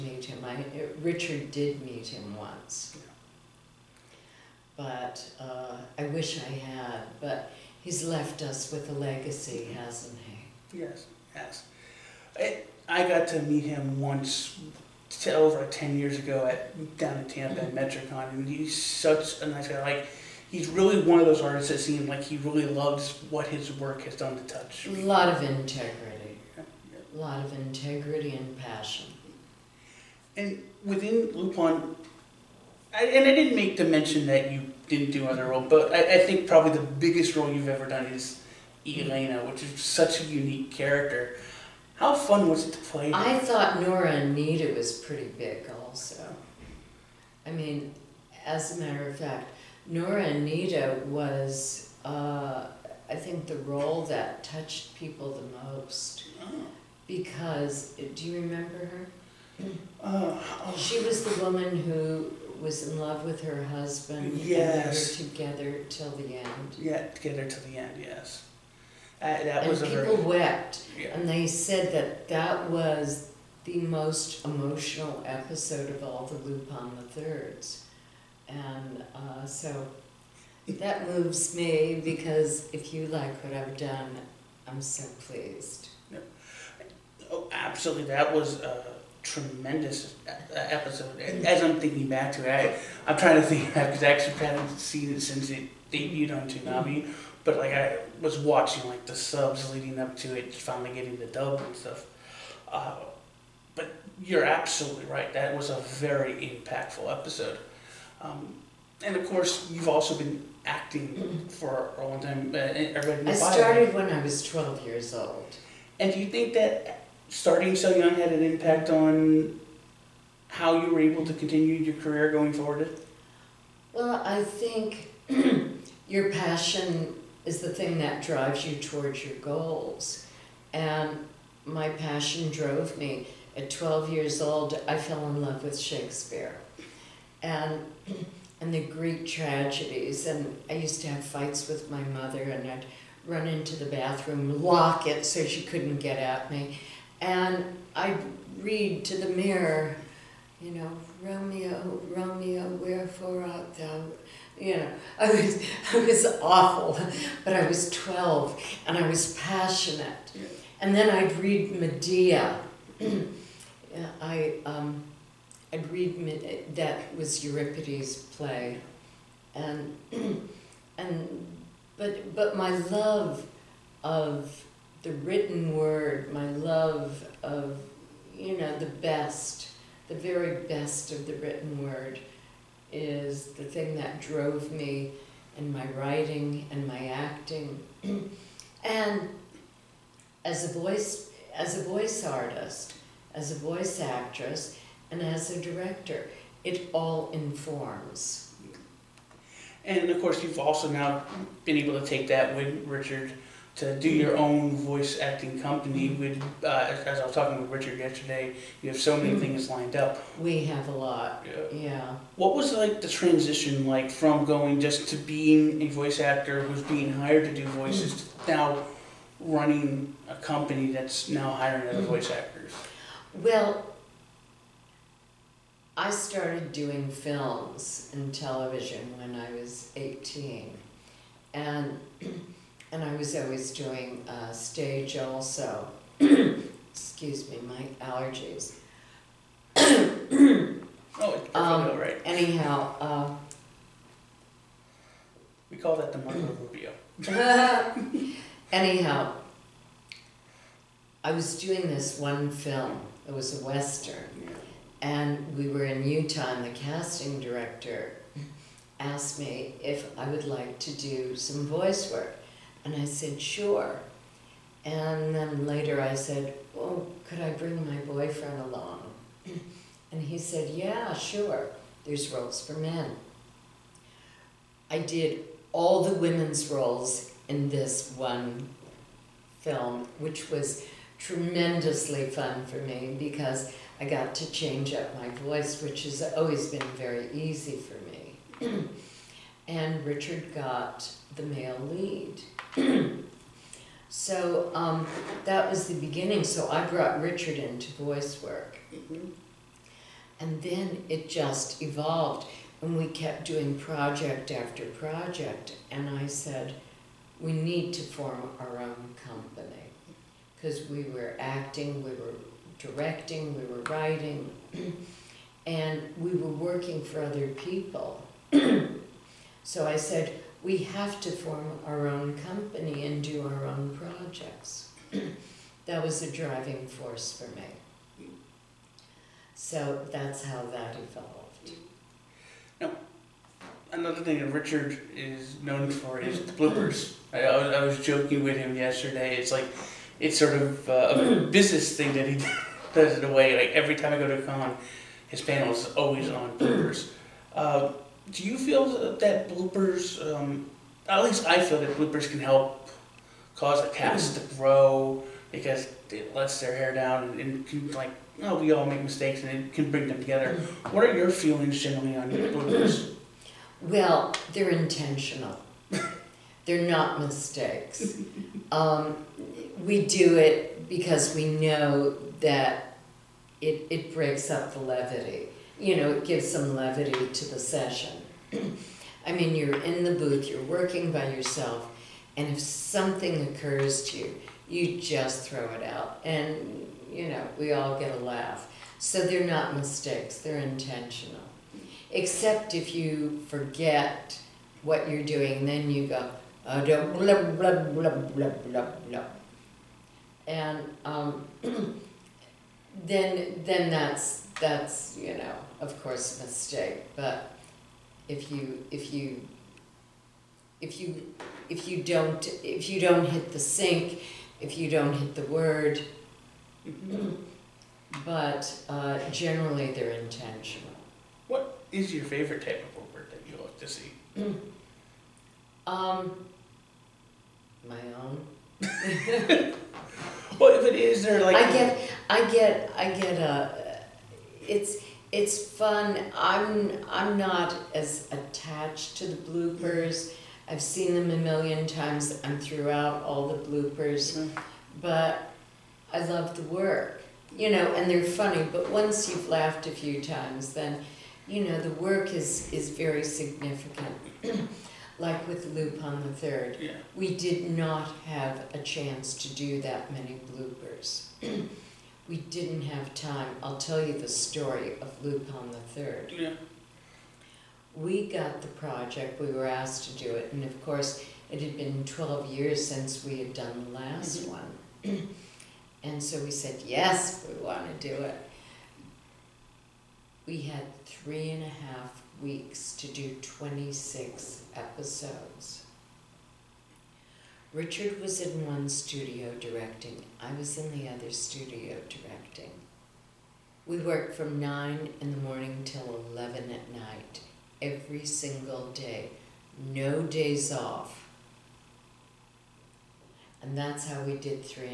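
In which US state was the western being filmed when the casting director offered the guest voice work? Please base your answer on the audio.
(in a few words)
Utah.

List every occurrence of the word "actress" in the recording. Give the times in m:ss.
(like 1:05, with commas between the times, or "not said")
3:13.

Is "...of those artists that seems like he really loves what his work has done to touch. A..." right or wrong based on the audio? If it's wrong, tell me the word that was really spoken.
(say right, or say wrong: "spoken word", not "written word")
right.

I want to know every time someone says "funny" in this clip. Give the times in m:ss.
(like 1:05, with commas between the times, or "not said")
7:28.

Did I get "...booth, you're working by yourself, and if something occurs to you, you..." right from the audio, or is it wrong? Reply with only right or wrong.
right.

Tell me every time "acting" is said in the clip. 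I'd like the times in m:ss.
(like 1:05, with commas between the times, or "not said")
1:50, 3:07, 3:25, 5:11.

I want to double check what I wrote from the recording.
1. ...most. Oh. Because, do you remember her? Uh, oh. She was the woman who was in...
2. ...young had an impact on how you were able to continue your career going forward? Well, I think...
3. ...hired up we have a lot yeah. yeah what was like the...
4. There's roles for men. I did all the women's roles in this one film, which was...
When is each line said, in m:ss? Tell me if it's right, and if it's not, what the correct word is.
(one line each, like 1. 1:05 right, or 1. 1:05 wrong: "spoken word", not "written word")
1. 0:55 right
2. 1:57 right
3. 3:29 wrong: "lined", not "hired"
4. 4:32 right.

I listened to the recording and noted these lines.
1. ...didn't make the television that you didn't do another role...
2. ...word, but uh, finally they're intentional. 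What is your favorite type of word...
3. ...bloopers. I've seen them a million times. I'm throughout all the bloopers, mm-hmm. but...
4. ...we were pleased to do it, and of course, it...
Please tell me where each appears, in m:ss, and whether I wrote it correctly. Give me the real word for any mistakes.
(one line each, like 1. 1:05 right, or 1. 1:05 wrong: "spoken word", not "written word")
1. 0:33 wrong: "mention", not "television"
2. 6:55 wrong: "generally", not "finally"
3. 7:19 right
4. 7:49 wrong: "asked", not "pleased".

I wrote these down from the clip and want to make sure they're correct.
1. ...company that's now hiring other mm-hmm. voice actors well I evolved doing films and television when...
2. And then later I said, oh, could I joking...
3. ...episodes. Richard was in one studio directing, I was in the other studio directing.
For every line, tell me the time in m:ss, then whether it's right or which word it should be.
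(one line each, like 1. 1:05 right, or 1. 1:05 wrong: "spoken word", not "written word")
1. 3:40 wrong: "started", not "evolved"
2. 4:24 wrong: "bring", not "joking"
3. 8:04 right.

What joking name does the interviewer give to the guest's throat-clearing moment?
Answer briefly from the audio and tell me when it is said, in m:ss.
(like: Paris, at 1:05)
the Marco Rubio, at 4:06.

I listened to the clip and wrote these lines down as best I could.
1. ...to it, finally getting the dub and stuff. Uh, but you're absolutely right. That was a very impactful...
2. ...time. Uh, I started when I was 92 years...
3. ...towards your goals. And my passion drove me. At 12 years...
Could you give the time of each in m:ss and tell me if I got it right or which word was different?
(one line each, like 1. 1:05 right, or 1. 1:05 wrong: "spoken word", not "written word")
1. 1:40 right
2. 1:52 wrong: "12", not "92"
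3. 2:08 right.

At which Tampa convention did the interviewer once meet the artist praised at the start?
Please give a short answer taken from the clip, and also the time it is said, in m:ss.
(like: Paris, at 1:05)
MetroCon, at 0:17.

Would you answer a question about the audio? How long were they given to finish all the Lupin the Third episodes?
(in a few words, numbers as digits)
three and a half weeks.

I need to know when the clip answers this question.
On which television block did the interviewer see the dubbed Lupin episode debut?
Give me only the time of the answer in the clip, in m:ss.
1:36.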